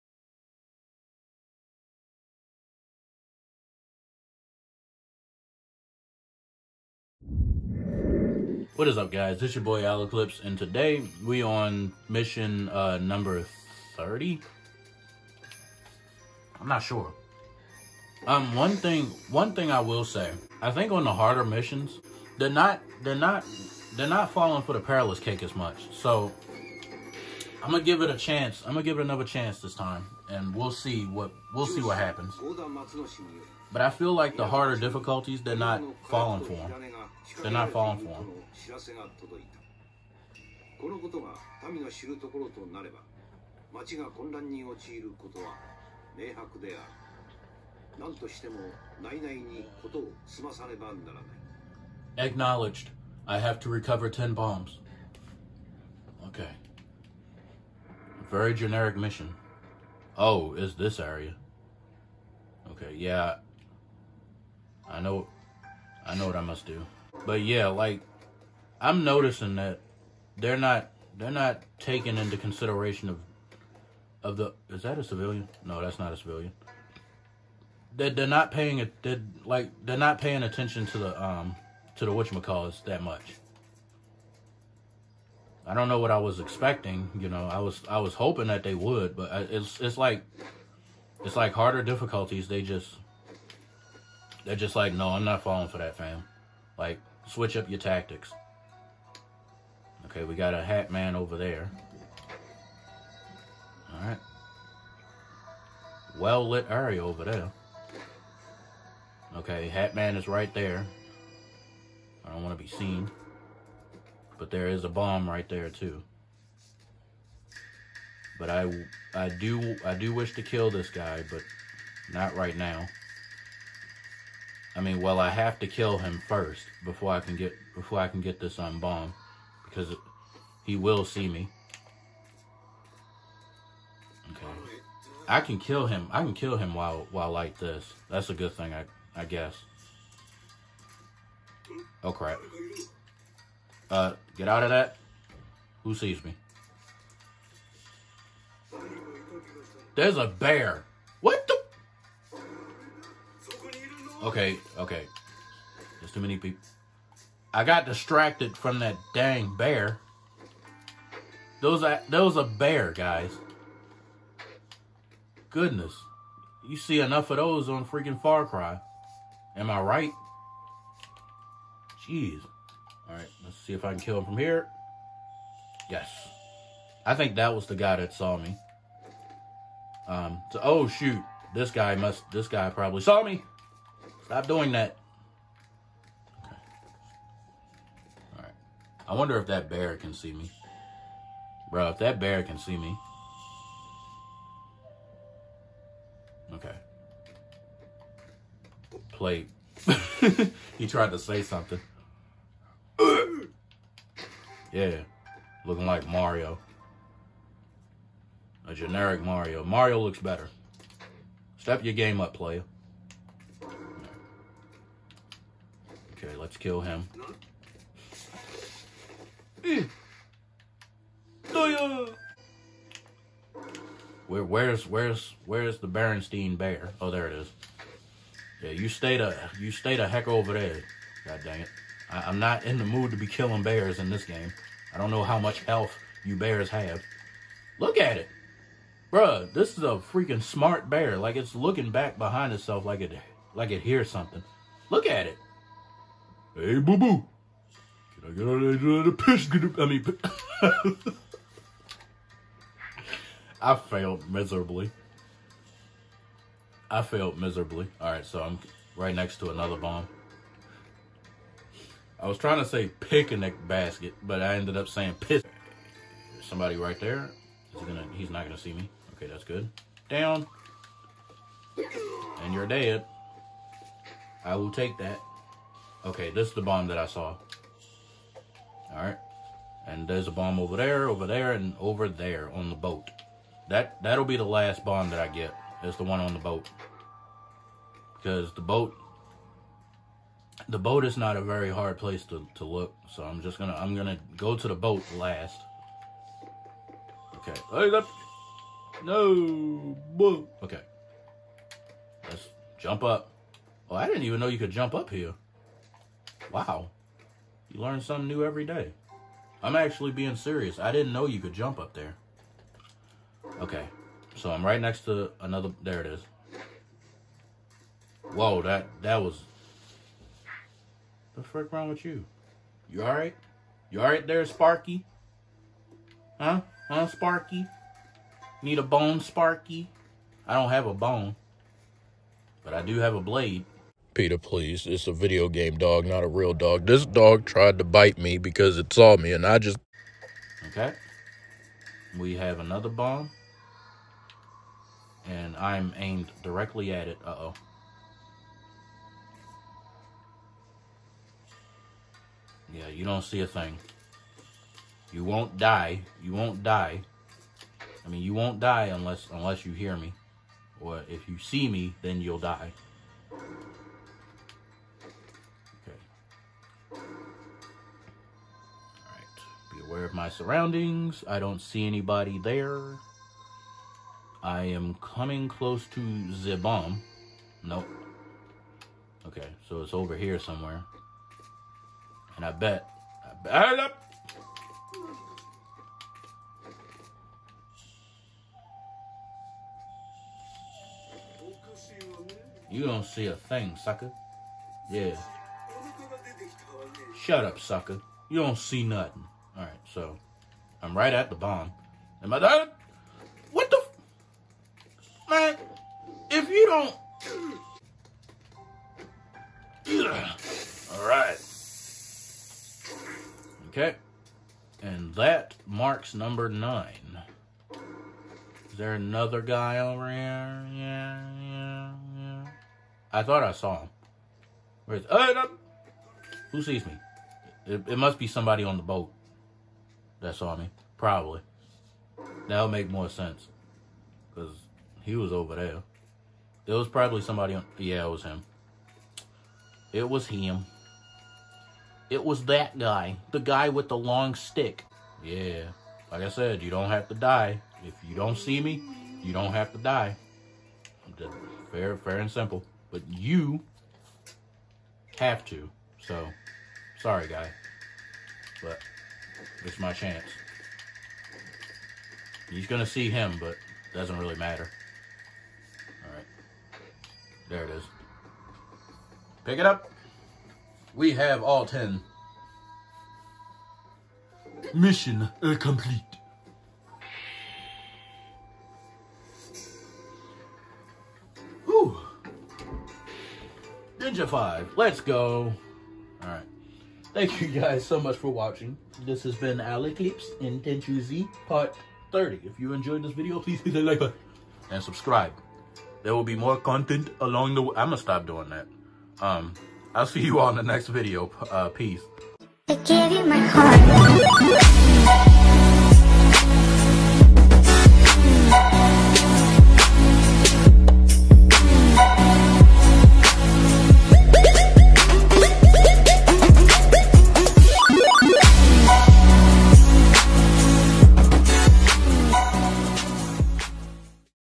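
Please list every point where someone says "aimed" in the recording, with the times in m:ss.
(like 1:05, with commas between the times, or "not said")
5:45.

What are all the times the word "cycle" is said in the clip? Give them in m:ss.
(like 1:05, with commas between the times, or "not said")
not said.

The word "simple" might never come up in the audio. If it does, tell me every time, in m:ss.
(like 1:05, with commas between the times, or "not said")
7:32.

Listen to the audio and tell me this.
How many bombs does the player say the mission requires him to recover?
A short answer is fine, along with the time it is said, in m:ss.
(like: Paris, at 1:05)
10, at 0:54.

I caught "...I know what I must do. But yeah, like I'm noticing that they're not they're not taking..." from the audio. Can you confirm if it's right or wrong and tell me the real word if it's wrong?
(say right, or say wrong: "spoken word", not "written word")
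right.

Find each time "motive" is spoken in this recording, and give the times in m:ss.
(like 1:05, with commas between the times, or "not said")
not said.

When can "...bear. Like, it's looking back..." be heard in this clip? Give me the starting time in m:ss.
4:00.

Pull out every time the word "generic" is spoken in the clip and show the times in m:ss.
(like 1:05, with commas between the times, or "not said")
0:58, 3:28.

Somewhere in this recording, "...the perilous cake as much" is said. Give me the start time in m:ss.
0:24.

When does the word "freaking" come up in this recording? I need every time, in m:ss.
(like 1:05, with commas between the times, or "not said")
2:47, 4:00.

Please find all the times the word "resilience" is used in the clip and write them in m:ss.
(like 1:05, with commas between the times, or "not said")
not said.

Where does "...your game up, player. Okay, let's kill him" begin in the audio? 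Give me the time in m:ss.
3:31.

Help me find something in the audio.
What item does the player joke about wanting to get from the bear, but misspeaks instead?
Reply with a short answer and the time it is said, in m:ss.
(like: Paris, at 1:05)
Picnic basket, at 4:22.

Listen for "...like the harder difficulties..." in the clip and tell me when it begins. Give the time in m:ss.
0:34.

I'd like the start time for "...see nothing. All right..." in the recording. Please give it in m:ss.
6:38.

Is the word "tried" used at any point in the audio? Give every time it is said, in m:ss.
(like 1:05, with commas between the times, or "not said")
3:20, 5:37.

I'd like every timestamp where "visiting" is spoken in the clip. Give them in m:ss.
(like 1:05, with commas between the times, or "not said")
not said.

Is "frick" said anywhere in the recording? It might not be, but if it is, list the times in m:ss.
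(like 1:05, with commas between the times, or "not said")
5:21.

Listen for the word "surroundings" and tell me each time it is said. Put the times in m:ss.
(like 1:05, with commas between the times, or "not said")
6:10.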